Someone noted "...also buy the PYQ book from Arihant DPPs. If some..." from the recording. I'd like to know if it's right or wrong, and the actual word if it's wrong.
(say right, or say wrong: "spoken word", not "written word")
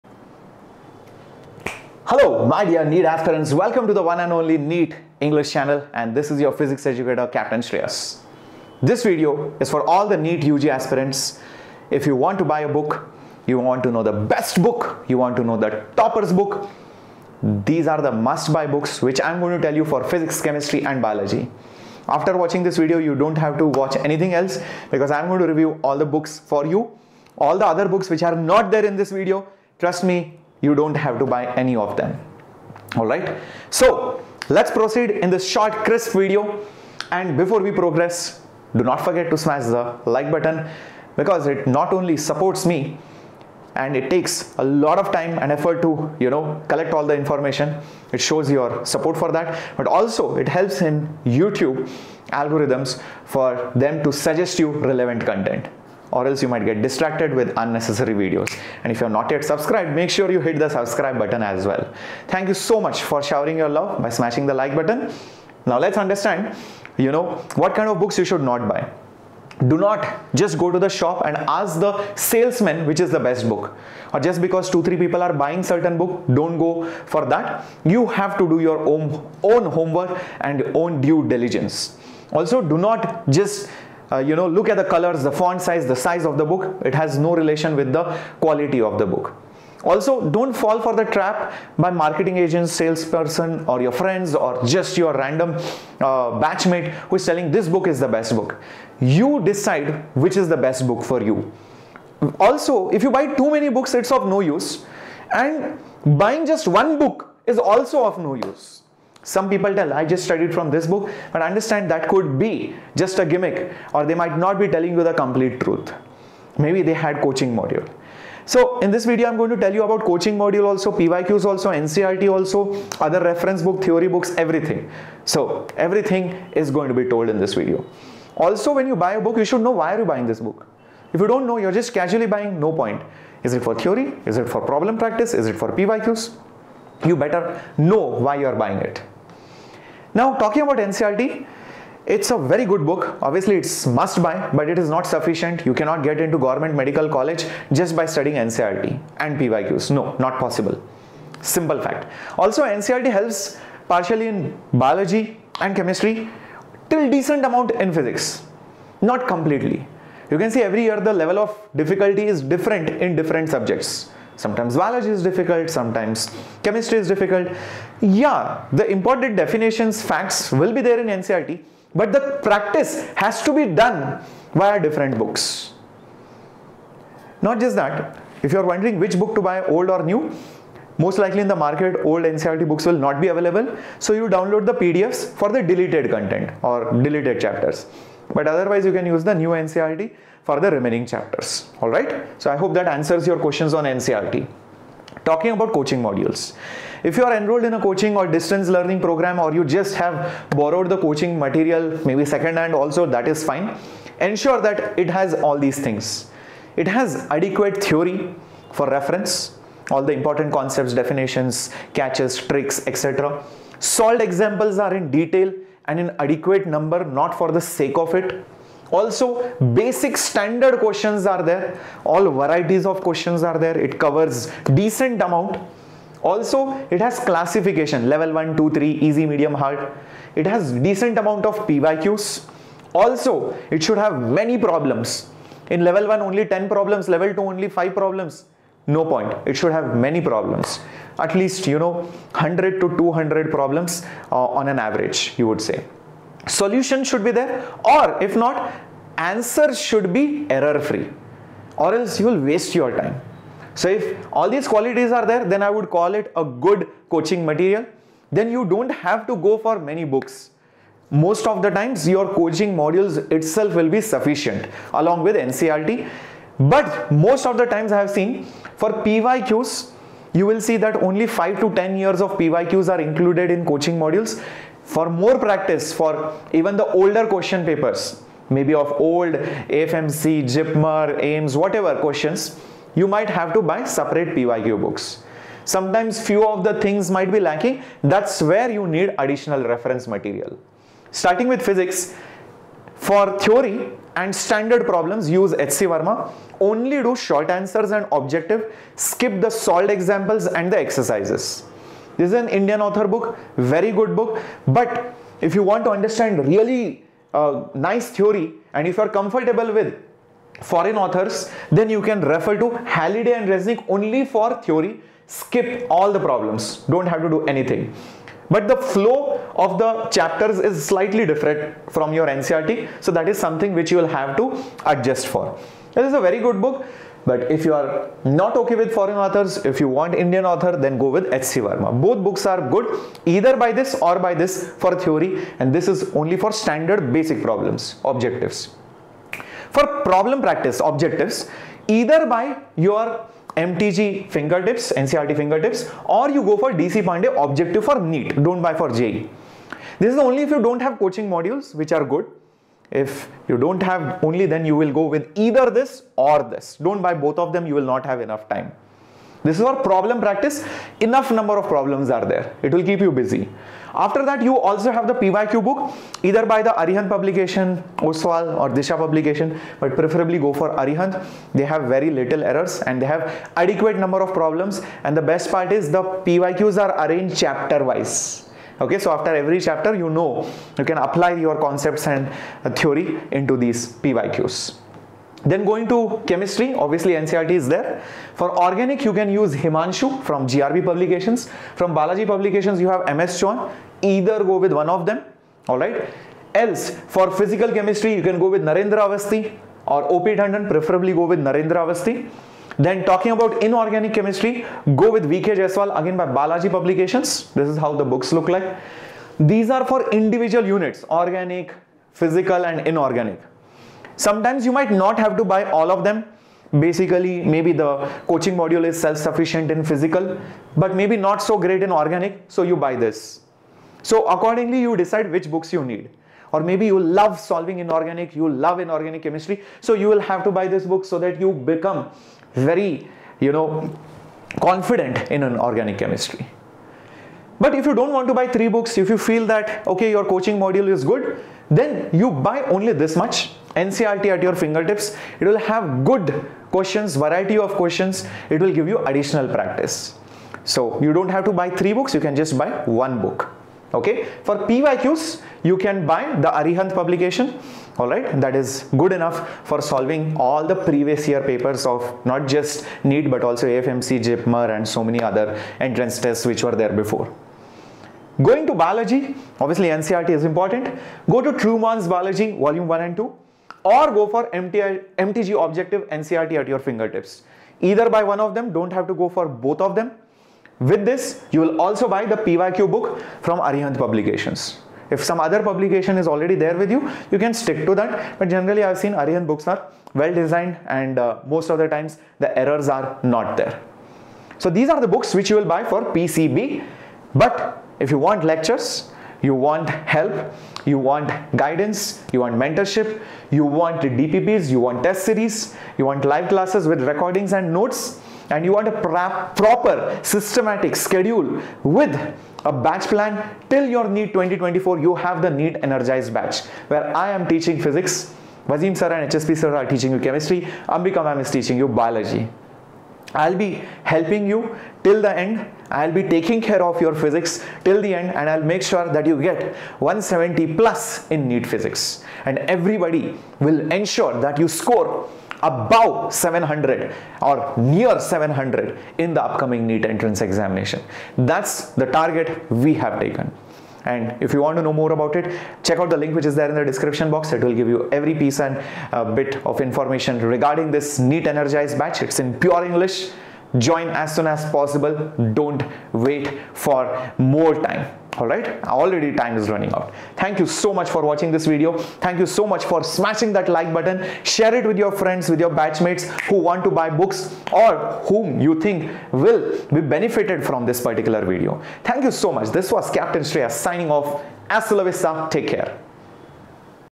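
wrong: "Publications", not "DPPs".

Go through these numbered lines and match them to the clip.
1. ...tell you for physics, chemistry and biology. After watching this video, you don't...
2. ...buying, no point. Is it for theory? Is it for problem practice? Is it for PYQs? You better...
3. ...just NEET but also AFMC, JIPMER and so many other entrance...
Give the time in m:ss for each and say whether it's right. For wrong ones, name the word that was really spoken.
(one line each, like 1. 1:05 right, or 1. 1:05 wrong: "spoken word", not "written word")
1. 0:19 right
2. 2:12 right
3. 7:42 right.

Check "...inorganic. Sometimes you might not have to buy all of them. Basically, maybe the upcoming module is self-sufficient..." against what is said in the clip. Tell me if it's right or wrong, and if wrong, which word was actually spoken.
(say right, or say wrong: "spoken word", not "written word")
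wrong: "coaching", not "upcoming".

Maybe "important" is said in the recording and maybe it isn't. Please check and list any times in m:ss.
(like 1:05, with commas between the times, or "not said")
2:48, 3:30, 7:50.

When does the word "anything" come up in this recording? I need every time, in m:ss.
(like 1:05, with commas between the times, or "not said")
0:23, 5:17.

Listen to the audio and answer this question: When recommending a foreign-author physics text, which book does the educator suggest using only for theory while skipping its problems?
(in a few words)
Halliday and Resnick.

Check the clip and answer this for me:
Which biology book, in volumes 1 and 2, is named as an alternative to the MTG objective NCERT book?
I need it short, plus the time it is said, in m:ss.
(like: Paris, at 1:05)
Trueman's Biology, at 7:51.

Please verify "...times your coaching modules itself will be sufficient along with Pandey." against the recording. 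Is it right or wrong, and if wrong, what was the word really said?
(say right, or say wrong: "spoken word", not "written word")
wrong: "NCRT", not "Pandey".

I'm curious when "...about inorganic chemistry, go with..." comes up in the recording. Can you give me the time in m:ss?
6:43.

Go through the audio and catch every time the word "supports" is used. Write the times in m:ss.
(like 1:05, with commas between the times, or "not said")
0:42, 0:48.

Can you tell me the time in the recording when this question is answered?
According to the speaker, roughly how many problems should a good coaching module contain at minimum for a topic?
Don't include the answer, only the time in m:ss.
4:02.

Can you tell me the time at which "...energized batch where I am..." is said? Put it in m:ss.
8:35.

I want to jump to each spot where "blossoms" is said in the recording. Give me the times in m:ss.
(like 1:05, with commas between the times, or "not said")
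not said.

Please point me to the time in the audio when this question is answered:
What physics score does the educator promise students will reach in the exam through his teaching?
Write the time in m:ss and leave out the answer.
8:49.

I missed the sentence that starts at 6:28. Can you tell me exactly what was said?
For organic, you can use Himanshu from GRB publications.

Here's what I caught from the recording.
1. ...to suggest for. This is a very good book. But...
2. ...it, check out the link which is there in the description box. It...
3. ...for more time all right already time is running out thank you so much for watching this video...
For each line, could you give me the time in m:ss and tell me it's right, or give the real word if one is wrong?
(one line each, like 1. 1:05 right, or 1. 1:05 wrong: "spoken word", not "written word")
1. 5:24 wrong: "adjust", not "suggest"
2. 9:05 right
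3. 9:16 right.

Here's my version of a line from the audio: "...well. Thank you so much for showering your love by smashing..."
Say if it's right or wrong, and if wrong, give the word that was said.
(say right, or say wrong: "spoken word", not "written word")
right.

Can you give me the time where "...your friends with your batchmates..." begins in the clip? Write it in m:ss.
9:24.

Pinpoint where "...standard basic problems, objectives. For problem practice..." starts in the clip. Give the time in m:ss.
5:36.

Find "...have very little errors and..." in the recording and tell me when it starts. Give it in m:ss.
6:11.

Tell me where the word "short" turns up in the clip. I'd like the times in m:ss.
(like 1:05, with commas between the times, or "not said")
0:35, 4:57.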